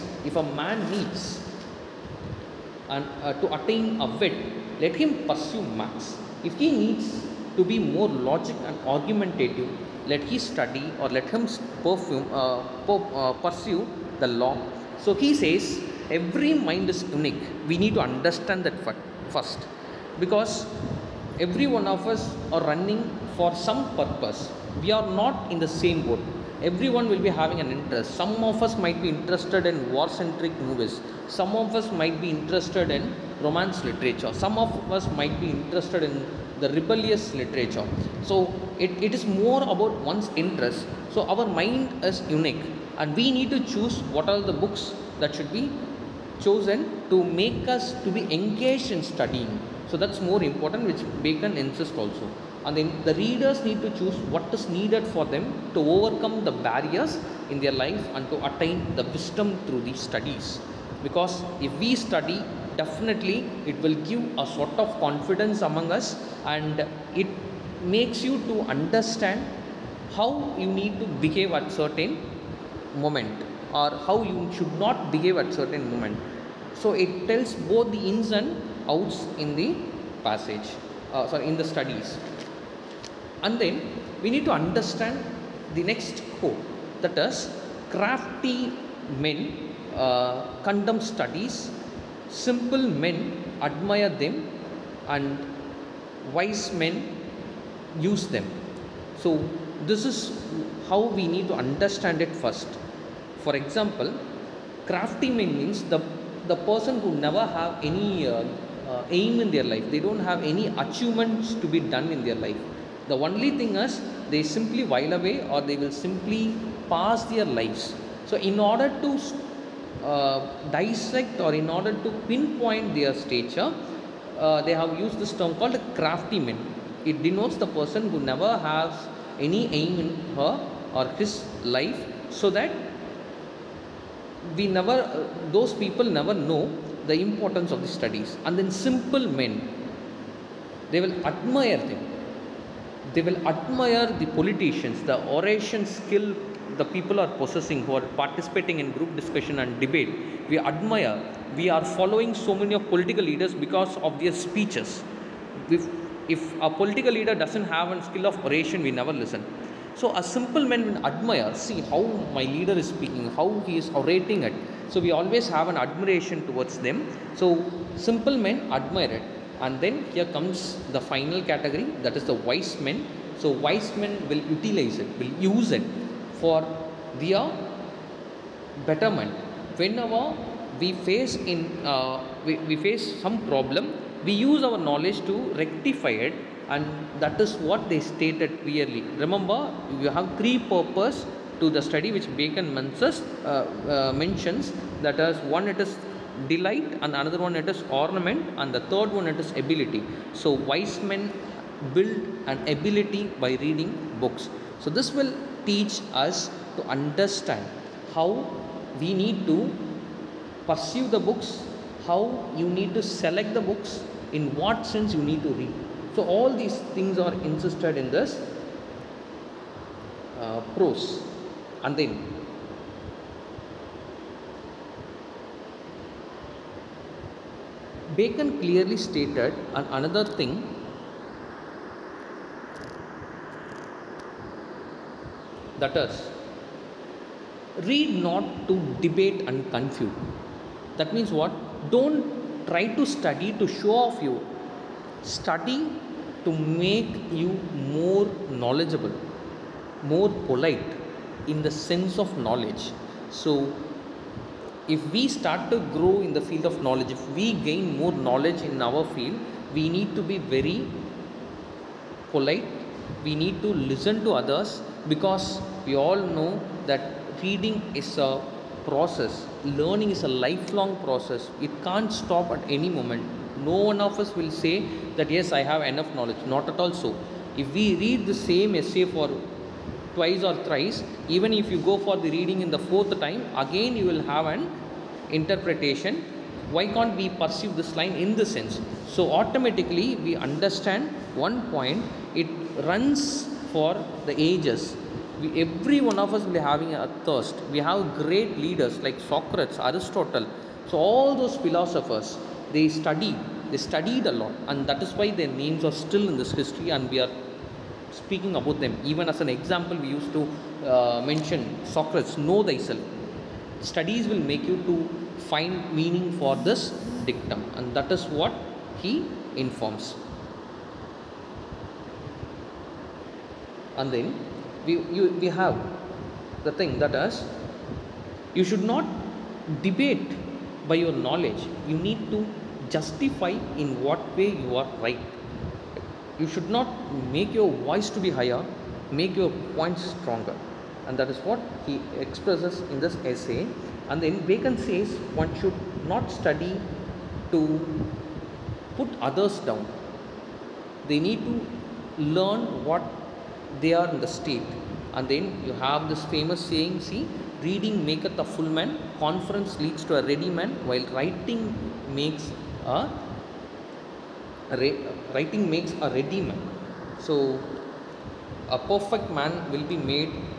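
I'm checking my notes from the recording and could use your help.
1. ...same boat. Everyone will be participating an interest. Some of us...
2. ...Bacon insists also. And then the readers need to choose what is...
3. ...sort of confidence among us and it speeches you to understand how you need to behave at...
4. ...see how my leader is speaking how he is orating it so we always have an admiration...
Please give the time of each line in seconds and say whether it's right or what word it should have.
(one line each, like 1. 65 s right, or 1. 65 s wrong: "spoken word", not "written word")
1. 25 s wrong: "having", not "participating"
2. 51 s right
3. 64 s wrong: "makes", not "speeches"
4. 161 s right.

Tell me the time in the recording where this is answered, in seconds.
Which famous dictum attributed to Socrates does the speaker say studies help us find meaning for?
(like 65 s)
312 s.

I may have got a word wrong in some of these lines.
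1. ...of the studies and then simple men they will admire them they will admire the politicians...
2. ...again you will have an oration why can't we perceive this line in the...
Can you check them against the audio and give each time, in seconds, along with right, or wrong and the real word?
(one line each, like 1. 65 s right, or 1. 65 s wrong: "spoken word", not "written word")
1. 137 s right
2. 283 s wrong: "interpretation", not "oration".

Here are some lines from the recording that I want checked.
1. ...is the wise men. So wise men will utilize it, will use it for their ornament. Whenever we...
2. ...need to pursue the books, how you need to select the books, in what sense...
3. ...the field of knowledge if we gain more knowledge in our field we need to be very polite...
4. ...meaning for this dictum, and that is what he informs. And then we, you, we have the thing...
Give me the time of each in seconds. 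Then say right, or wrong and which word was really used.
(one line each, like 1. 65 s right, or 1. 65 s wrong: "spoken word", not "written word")
1. 172 s wrong: "betterment", not "ornament"
2. 209 s right
3. 256 s right
4. 315 s right.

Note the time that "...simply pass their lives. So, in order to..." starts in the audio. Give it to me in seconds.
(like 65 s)
115 s.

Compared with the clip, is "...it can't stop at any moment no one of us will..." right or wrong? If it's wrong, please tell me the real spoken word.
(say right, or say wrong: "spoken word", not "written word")
right.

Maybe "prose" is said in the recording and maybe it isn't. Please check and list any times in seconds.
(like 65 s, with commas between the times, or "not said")
220 s.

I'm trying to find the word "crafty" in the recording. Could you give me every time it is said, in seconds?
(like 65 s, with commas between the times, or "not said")
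87 s, 104 s, 125 s.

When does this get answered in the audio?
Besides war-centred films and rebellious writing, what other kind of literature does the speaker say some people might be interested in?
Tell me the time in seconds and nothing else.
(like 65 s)
33 s.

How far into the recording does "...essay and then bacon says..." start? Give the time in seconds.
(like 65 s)
343 s.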